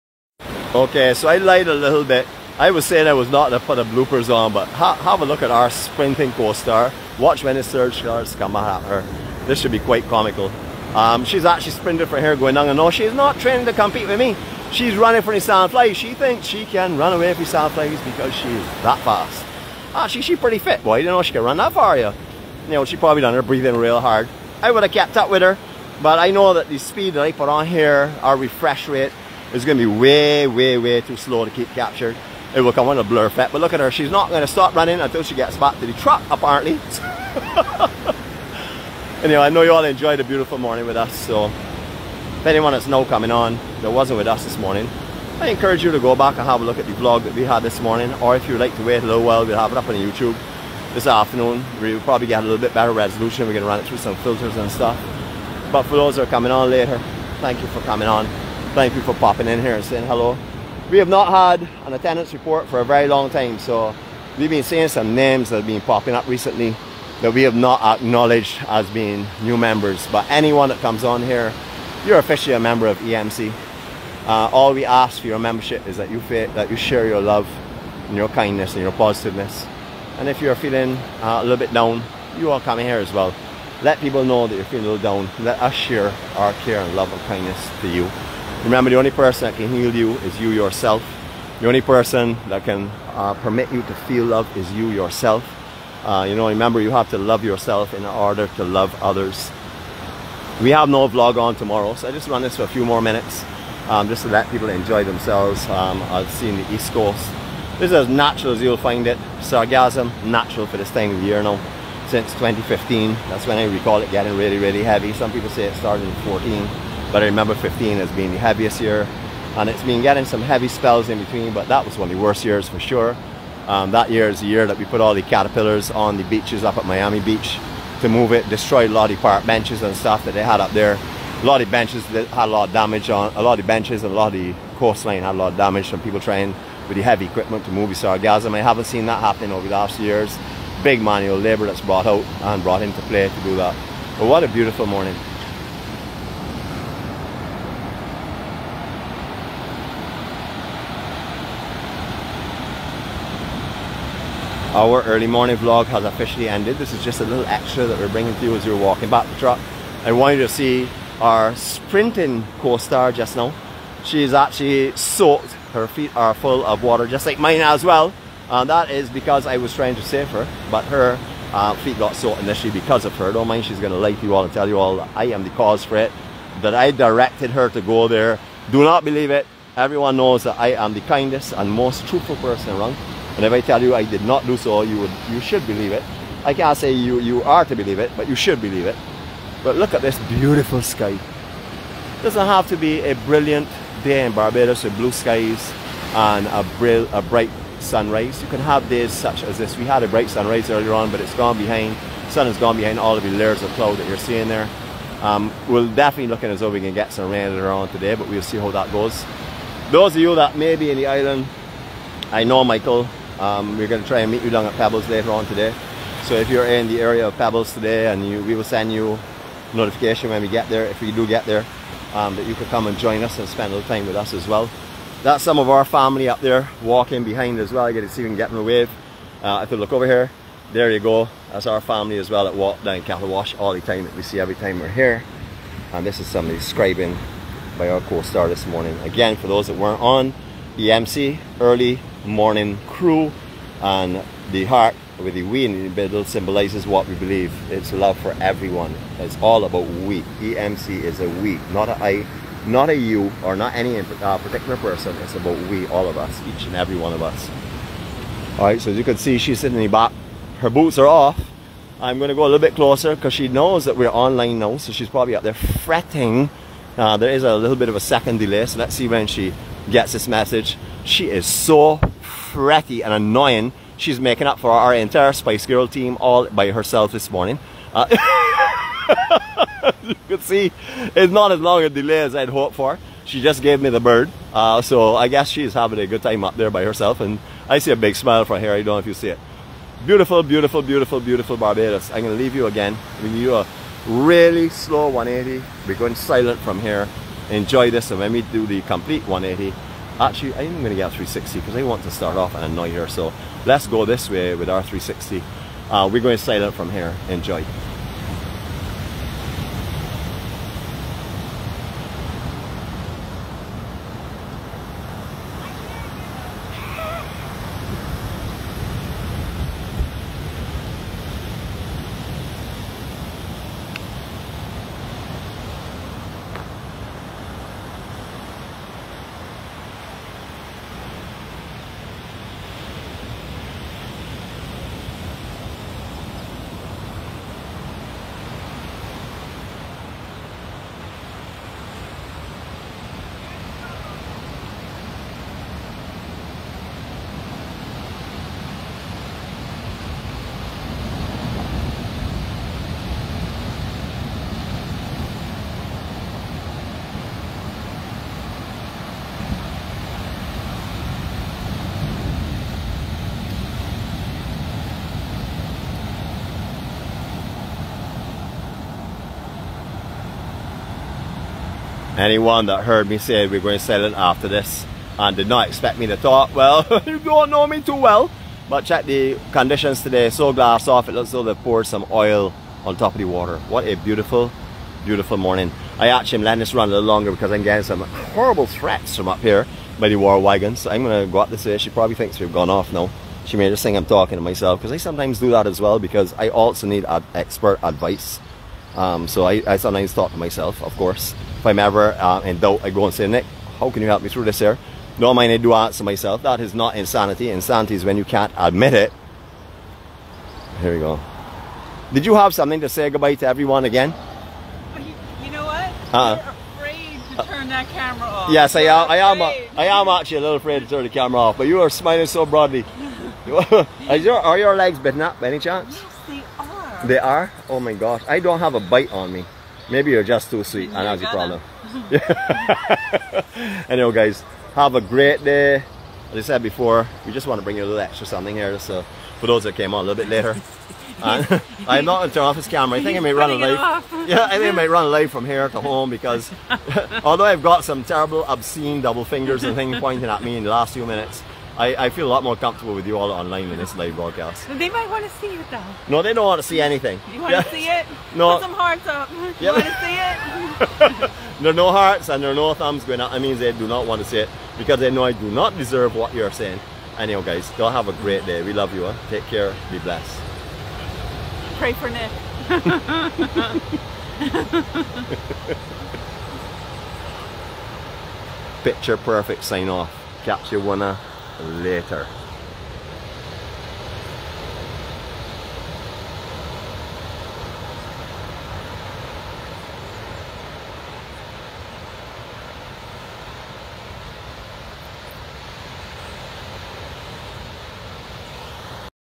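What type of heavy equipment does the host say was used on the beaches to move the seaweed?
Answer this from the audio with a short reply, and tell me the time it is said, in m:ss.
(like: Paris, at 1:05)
caterpillars, at 2:05.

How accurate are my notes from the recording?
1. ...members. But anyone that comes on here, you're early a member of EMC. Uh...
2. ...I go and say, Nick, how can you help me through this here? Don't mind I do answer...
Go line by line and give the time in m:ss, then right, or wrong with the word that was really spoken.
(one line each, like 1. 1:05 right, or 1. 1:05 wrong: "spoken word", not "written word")
1. 1:09 wrong: "officially", not "early"
2. 6:42 right.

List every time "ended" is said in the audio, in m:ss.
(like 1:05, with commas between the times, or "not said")
2:36.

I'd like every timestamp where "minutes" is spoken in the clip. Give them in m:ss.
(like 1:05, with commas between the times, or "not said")
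1:43, 7:31.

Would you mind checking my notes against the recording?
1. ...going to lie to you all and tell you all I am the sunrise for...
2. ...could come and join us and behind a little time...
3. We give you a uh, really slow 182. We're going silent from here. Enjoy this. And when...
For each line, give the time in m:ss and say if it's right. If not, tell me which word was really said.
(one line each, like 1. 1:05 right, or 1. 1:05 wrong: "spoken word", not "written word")
1. 2:53 wrong: "cause", not "sunrise"
2. 3:42 wrong: "spend", not "behind"
3. 4:53 wrong: "180", not "182".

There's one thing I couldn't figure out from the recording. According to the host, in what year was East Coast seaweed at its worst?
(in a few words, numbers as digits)
2015.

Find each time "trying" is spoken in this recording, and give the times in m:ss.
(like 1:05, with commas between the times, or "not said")
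2:16, 2:49.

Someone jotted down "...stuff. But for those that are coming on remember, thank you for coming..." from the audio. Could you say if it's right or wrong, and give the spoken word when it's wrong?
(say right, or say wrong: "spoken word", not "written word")
wrong: "later", not "remember".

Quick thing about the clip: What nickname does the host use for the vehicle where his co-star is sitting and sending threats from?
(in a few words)
war wagon.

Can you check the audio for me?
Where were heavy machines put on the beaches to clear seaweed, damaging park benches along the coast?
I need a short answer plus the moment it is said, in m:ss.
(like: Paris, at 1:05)
Miami Beach, at 2:06.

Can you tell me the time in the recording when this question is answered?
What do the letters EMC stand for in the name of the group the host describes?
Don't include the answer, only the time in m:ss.
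4:01.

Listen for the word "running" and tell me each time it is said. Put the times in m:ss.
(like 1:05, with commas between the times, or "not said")
0:14, 0:34.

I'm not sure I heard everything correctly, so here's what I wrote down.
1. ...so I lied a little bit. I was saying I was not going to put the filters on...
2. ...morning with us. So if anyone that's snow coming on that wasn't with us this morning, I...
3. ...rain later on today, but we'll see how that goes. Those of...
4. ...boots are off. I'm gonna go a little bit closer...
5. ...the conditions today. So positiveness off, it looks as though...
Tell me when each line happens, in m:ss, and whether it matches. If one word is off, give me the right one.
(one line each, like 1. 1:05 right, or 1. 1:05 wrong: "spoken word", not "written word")
1. 0:01 wrong: "bloopers", not "filters"
2. 0:40 right
3. 3:27 right
4. 4:20 right
5. 6:19 wrong: "glass", not "positiveness".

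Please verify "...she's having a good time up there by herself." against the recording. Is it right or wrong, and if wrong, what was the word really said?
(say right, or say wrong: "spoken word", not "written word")
right.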